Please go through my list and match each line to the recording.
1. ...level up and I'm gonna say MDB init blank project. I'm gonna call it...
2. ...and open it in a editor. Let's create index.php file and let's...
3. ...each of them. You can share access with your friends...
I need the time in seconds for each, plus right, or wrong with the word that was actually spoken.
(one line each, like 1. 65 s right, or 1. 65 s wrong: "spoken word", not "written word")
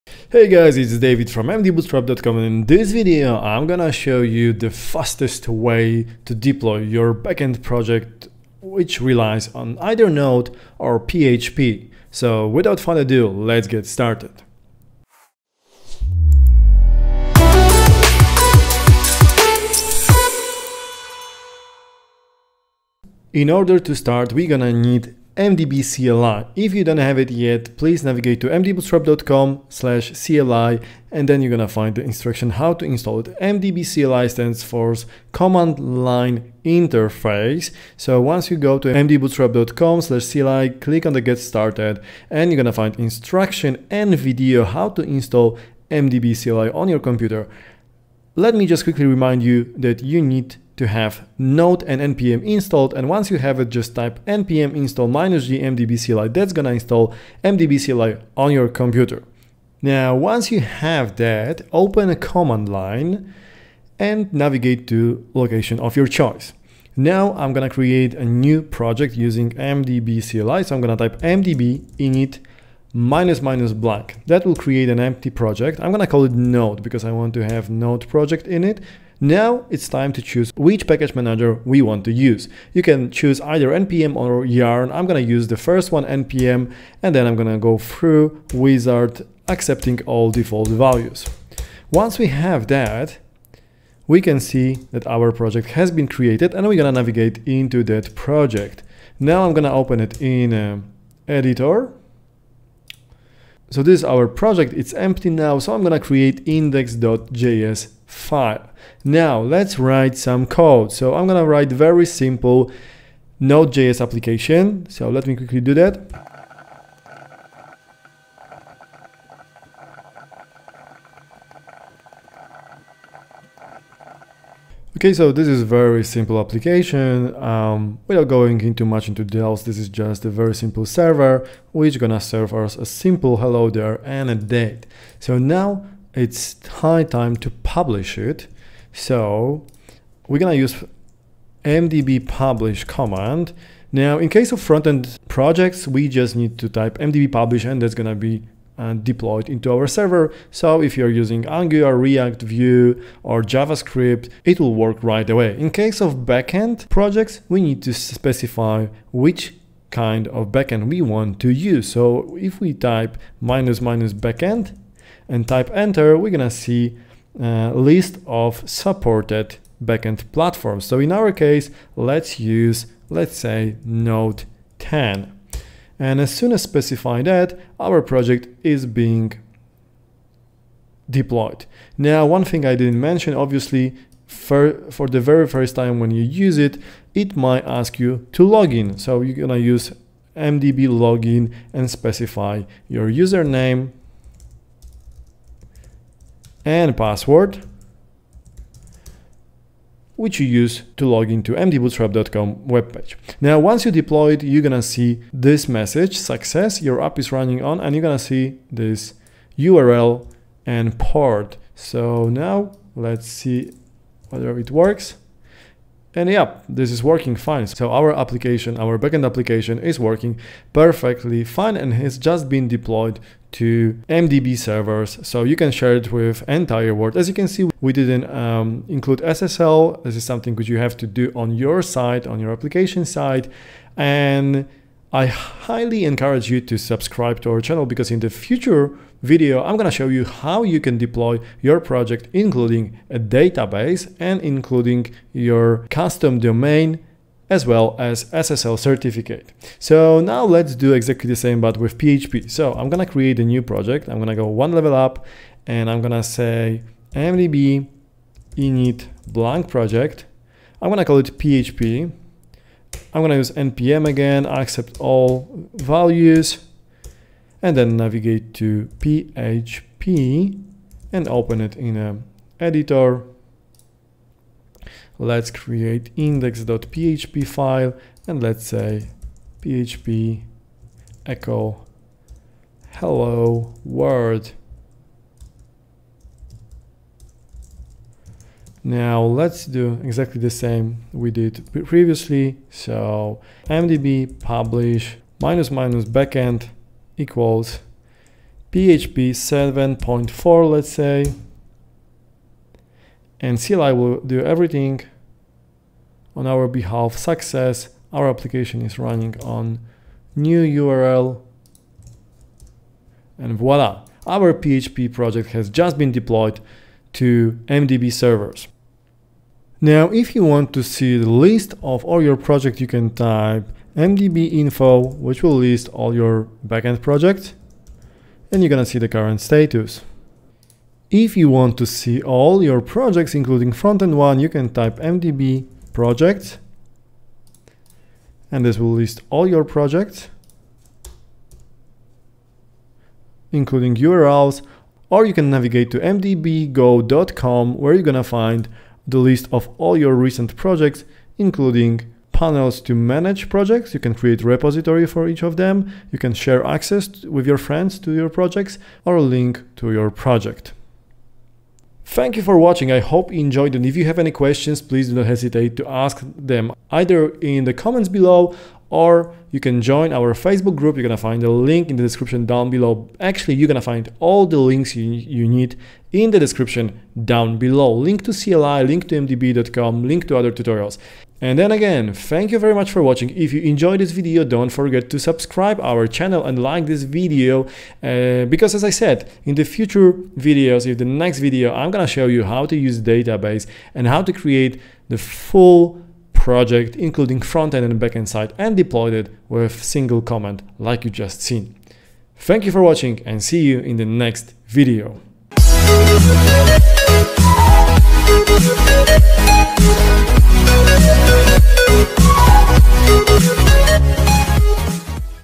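1. 254 s right
2. 271 s right
3. 355 s right.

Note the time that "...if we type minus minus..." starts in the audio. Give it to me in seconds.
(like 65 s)
162 s.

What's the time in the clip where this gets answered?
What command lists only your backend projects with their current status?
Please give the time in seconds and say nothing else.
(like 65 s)
323 s.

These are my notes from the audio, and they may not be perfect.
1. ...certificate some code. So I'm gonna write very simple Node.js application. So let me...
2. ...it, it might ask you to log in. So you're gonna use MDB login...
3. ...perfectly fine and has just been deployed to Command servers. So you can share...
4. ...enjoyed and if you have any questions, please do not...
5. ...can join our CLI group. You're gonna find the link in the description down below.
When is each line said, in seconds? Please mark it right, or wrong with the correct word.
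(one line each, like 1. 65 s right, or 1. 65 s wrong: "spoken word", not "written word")
1. 109 s wrong: "write", not "certificate"
2. 186 s right
3. 220 s wrong: "MDB", not "Command"
4. 363 s right
5. 369 s wrong: "Facebook", not "CLI".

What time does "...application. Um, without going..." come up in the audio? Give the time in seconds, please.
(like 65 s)
126 s.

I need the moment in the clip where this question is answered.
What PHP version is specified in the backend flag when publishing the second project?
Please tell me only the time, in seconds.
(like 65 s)
298 s.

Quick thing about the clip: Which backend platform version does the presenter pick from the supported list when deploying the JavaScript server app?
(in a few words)
Node 10.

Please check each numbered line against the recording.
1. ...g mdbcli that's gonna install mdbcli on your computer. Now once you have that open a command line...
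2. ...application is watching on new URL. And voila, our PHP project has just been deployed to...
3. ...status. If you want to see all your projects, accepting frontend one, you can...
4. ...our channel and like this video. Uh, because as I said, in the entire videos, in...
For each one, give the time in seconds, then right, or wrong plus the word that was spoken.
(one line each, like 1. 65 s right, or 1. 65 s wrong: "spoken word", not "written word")
1. 55 s right
2. 308 s wrong: "running", not "watching"
3. 329 s wrong: "including", not "accepting"
4. 385 s wrong: "future", not "entire".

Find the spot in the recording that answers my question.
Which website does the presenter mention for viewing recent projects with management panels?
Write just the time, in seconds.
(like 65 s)
345 s.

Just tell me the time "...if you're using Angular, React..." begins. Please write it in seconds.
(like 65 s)
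150 s.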